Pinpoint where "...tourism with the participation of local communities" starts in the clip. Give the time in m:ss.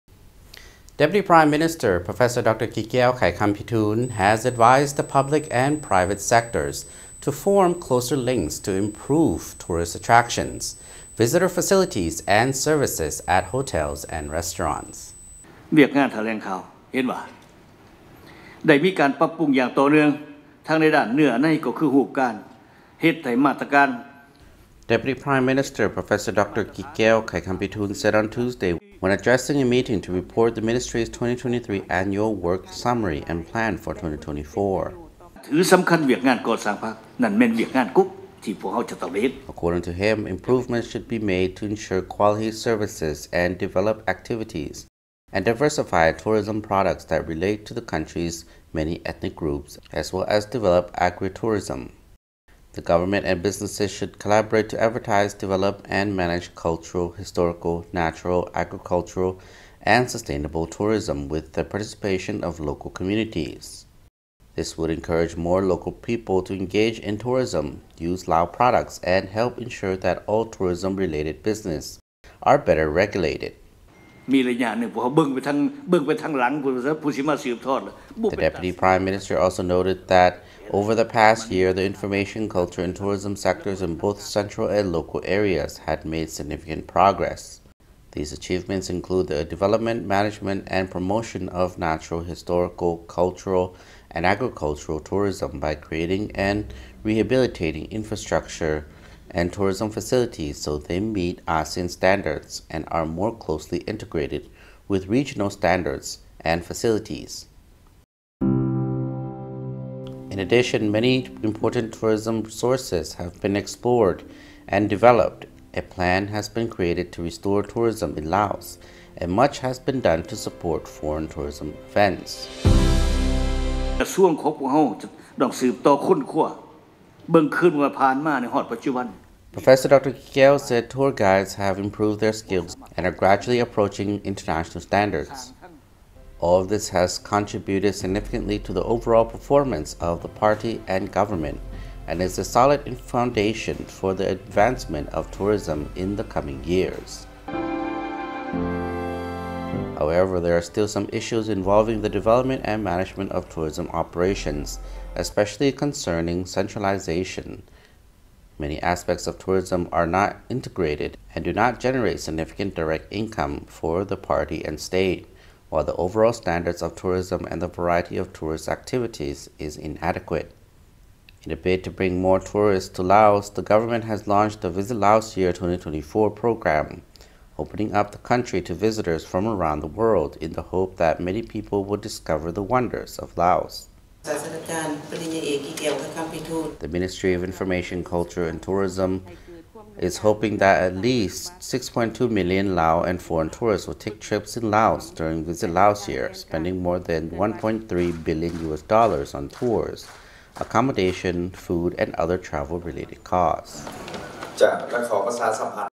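1:00.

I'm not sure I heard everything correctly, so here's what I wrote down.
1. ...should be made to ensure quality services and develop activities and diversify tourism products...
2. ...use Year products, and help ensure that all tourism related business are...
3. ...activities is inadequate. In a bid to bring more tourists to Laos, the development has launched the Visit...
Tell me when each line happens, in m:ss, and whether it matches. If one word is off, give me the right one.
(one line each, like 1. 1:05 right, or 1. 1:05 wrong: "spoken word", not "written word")
1. 0:40 right
2. 1:07 wrong: "Lao", not "Year"
3. 2:48 wrong: "government", not "development".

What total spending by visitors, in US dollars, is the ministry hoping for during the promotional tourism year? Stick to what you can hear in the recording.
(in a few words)
1.3 billion US dollars.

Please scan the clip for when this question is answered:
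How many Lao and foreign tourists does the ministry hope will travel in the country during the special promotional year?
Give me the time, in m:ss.
3:11.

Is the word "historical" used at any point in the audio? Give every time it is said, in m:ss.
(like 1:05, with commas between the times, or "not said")
0:57, 1:32.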